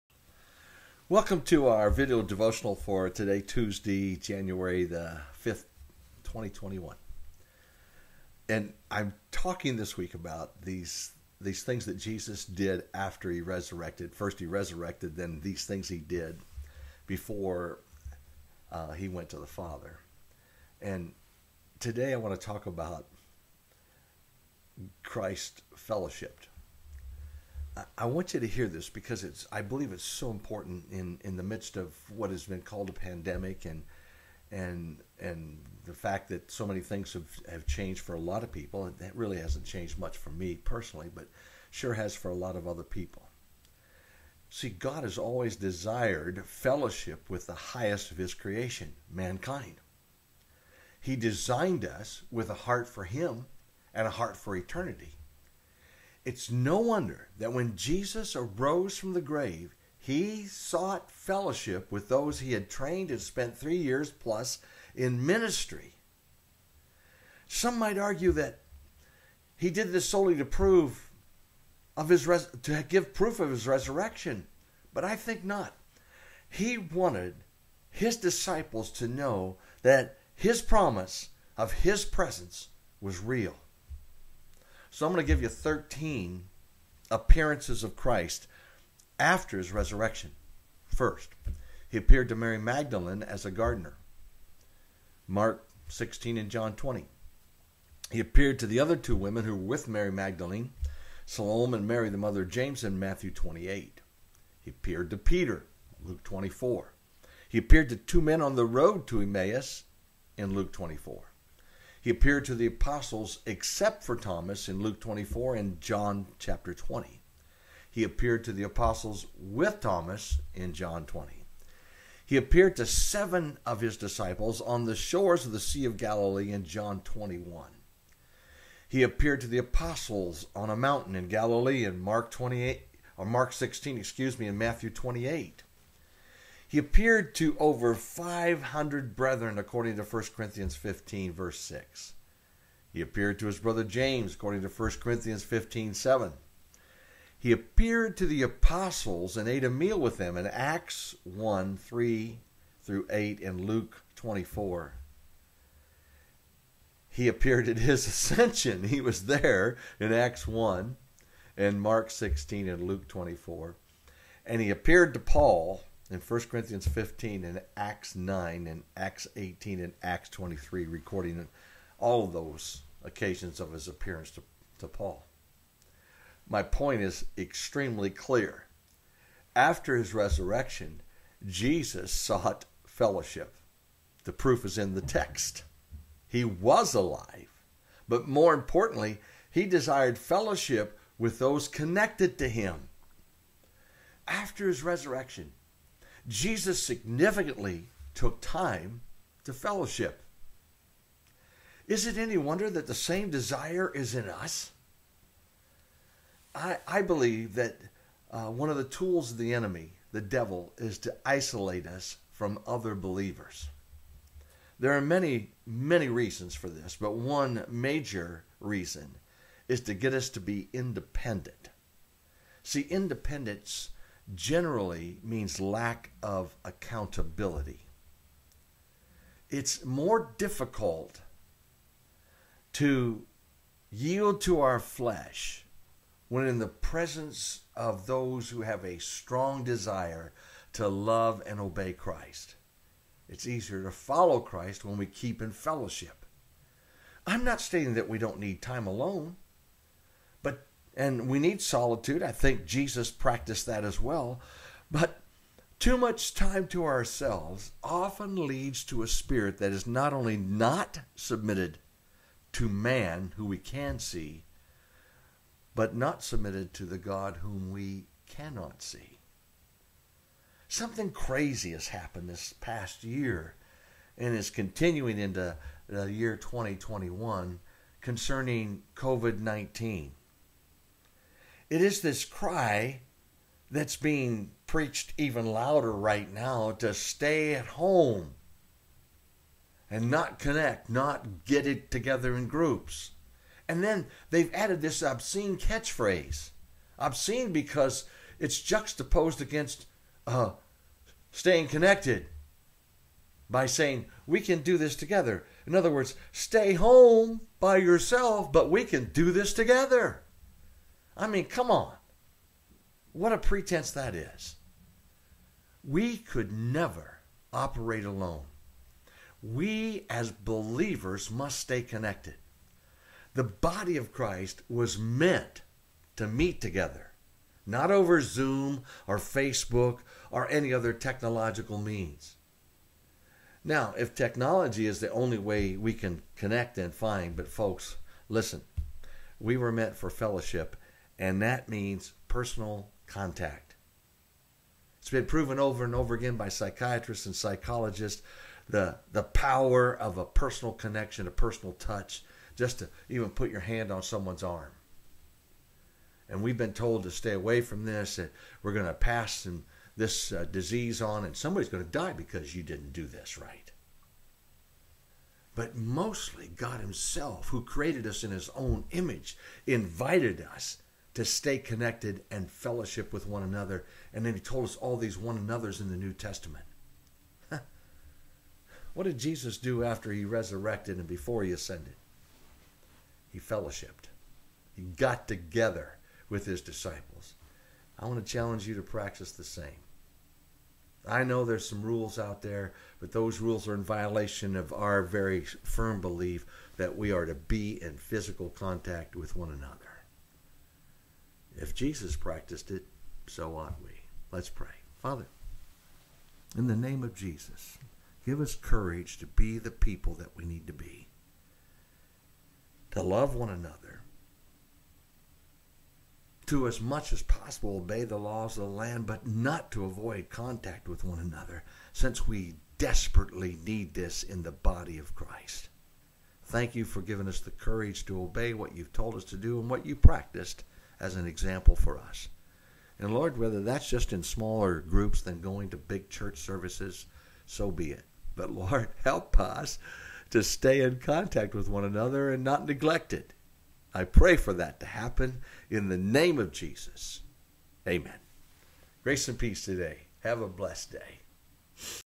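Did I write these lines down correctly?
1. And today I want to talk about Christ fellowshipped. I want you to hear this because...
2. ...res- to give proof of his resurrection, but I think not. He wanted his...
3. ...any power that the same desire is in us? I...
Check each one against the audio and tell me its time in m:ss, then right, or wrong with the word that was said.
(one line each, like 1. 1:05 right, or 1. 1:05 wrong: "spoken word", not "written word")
1. 0:20 right
2. 1:12 right
3. 3:22 wrong: "wonder", not "power".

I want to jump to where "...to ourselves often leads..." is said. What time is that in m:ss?
4:16.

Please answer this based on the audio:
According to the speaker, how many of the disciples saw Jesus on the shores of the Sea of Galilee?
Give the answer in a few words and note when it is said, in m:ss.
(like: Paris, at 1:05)
7, at 2:02.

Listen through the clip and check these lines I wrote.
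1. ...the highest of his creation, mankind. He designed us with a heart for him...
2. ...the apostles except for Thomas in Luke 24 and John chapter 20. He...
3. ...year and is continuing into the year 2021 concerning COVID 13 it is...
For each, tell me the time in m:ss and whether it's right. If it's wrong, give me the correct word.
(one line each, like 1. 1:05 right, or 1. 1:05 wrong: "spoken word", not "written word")
1. 0:47 right
2. 1:52 right
3. 4:33 wrong: "19", not "13".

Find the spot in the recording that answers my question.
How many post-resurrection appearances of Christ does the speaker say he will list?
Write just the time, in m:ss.
1:25.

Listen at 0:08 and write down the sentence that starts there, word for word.
And I'm talking this week about these these things that Jesus did after he resurrected.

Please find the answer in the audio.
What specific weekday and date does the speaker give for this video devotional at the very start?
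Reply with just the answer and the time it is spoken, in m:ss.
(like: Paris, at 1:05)
Tuesday, January 5th, 2021, at 0:03.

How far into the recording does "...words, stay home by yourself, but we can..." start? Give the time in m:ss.
5:05.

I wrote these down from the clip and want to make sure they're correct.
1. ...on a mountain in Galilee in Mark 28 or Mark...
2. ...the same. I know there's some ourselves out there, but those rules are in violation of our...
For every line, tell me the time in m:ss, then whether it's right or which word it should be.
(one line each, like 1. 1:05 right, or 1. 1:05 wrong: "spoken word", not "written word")
1. 2:10 right
2. 6:29 wrong: "rules", not "ourselves".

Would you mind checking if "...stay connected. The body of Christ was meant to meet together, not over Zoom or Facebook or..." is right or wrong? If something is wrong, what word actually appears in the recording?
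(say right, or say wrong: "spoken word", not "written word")
right.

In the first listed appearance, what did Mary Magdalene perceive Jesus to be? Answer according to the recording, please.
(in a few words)
A gardener.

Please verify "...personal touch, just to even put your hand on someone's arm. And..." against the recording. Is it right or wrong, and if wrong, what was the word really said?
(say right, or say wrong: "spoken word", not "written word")
right.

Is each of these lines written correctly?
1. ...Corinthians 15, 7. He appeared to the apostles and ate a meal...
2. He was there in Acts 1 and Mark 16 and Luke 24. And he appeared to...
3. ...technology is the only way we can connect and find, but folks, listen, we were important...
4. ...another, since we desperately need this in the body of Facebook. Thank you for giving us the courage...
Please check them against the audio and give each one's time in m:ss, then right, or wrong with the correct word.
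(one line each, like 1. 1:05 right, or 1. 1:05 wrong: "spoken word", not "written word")
1. 2:25 right
2. 2:38 right
3. 5:34 wrong: "meant", not "important"
4. 7:01 wrong: "Christ", not "Facebook".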